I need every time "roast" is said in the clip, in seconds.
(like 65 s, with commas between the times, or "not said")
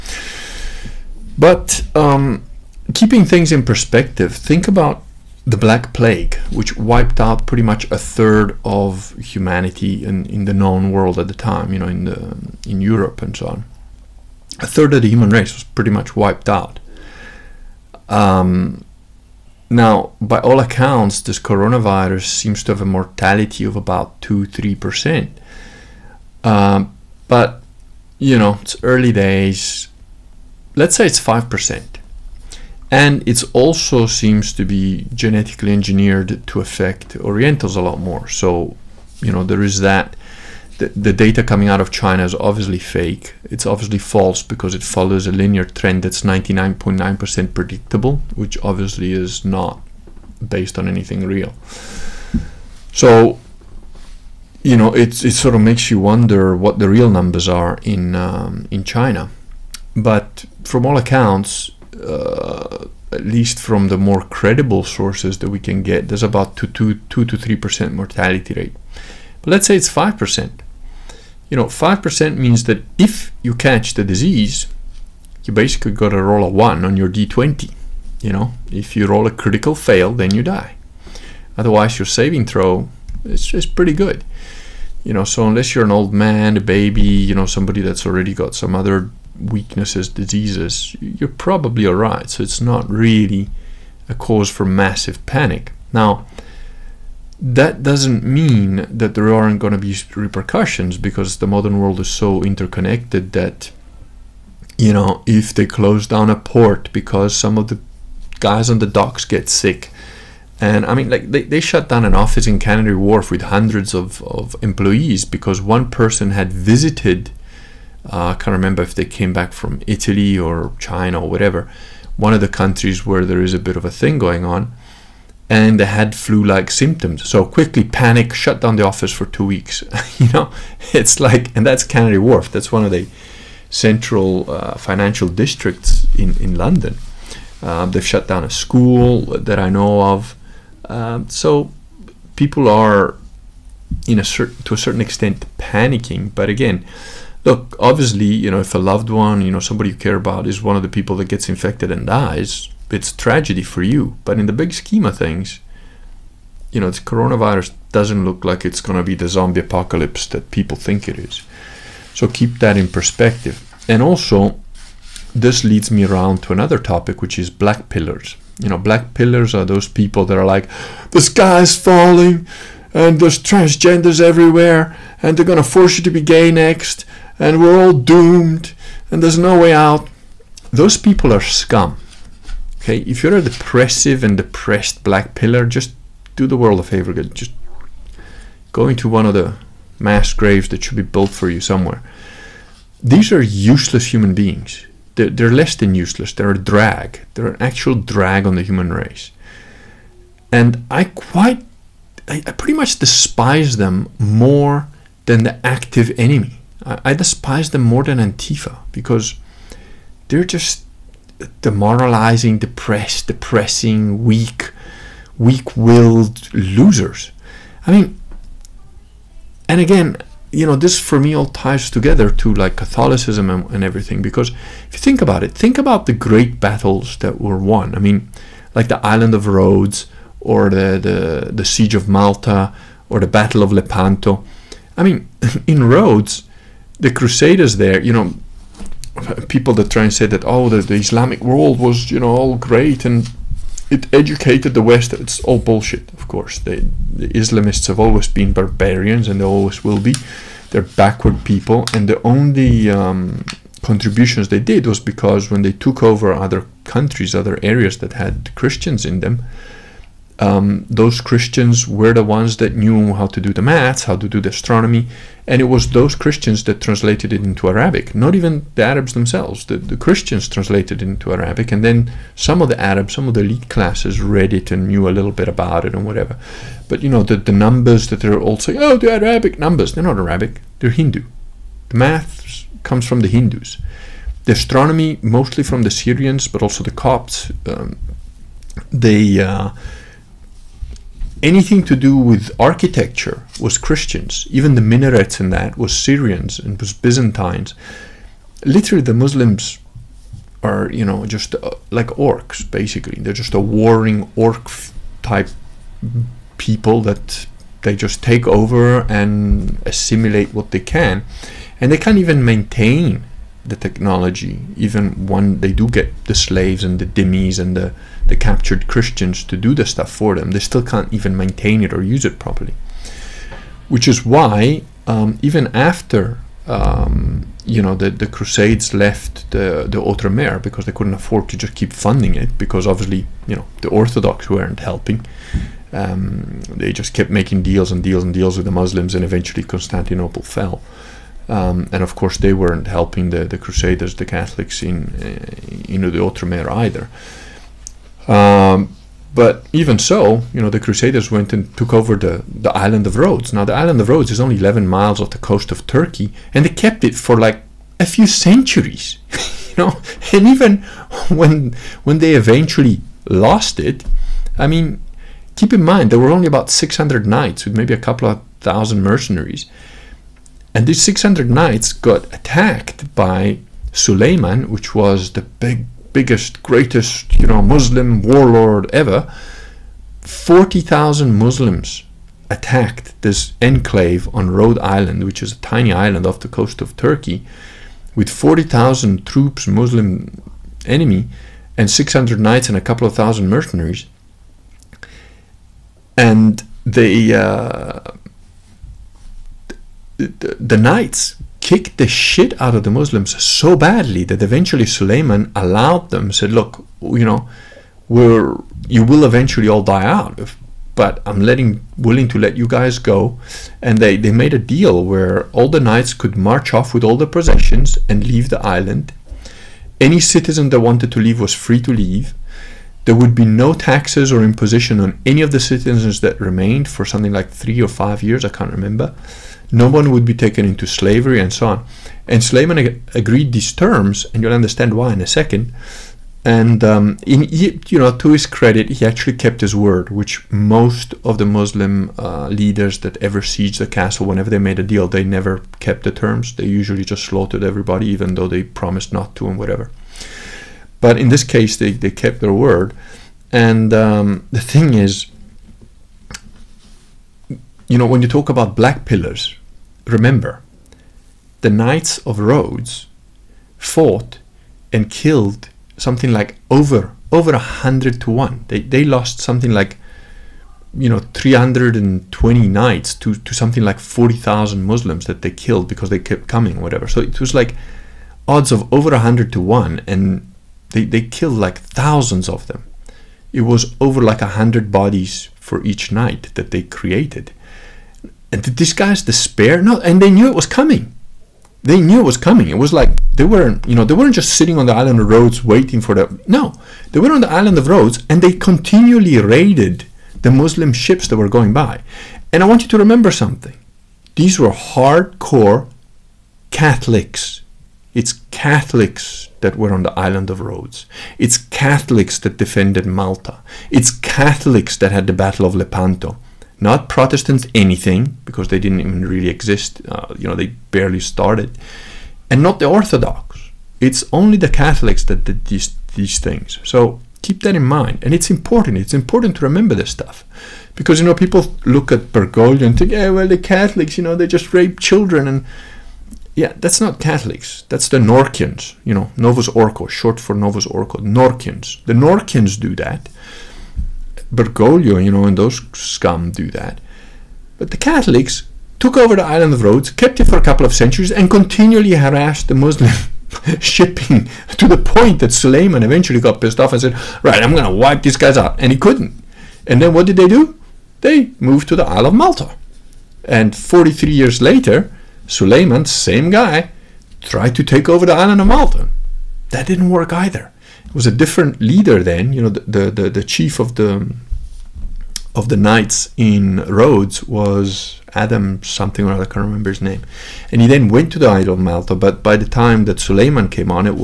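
not said.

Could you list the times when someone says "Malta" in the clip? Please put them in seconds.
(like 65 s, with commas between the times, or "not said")
232 s, 513 s, 562 s, 568 s, 581 s.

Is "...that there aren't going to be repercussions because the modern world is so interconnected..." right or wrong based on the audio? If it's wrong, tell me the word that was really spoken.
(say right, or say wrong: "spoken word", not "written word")
right.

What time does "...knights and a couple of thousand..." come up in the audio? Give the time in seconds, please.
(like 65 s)
392 s.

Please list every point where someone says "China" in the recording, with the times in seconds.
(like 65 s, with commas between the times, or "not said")
41 s, 58 s, 120 s.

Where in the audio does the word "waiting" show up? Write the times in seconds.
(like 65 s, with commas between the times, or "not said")
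495 s.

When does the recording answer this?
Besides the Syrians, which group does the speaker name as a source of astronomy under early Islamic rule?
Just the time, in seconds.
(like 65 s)
286 s.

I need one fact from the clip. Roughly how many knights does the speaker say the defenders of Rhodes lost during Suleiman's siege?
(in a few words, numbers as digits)
320.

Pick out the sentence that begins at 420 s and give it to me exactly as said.
Any citizen that wanted to leave was free to leave.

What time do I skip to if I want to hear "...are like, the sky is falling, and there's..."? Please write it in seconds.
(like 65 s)
170 s.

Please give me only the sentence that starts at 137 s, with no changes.
Um, they've shut down a school that I know of.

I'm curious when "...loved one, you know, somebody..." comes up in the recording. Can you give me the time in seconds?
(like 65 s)
148 s.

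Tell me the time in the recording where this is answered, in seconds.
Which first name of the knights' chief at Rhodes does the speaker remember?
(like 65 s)
578 s.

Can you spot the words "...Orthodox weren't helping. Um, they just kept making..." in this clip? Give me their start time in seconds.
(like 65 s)
333 s.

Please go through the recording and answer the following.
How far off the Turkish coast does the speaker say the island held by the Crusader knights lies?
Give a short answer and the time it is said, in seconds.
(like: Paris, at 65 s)
11 miles, at 354 s.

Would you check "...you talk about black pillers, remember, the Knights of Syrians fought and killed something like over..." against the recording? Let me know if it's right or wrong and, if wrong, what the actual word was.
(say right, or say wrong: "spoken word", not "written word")
wrong: "Rhodes", not "Syrians".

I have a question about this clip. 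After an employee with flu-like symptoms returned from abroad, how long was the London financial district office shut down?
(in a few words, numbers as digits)
2 weeks.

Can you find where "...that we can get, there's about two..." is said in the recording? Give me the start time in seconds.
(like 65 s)
65 s.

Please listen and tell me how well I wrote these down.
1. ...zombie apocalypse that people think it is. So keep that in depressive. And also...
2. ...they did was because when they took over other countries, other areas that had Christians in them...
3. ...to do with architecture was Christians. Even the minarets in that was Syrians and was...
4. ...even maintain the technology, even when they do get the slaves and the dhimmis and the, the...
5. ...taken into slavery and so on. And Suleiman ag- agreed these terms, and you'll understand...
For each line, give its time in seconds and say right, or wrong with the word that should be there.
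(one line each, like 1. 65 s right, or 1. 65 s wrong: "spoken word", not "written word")
1. 159 s wrong: "perspective", not "depressive"
2. 254 s right
3. 291 s right
4. 312 s right
5. 430 s right.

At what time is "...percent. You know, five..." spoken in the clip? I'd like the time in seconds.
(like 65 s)
70 s.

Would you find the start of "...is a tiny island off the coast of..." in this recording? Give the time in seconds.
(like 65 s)
385 s.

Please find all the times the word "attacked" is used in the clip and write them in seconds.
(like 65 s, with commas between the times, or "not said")
372 s, 382 s.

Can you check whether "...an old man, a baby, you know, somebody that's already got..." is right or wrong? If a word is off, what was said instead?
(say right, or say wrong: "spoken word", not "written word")
right.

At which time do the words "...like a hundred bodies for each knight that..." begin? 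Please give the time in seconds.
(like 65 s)
484 s.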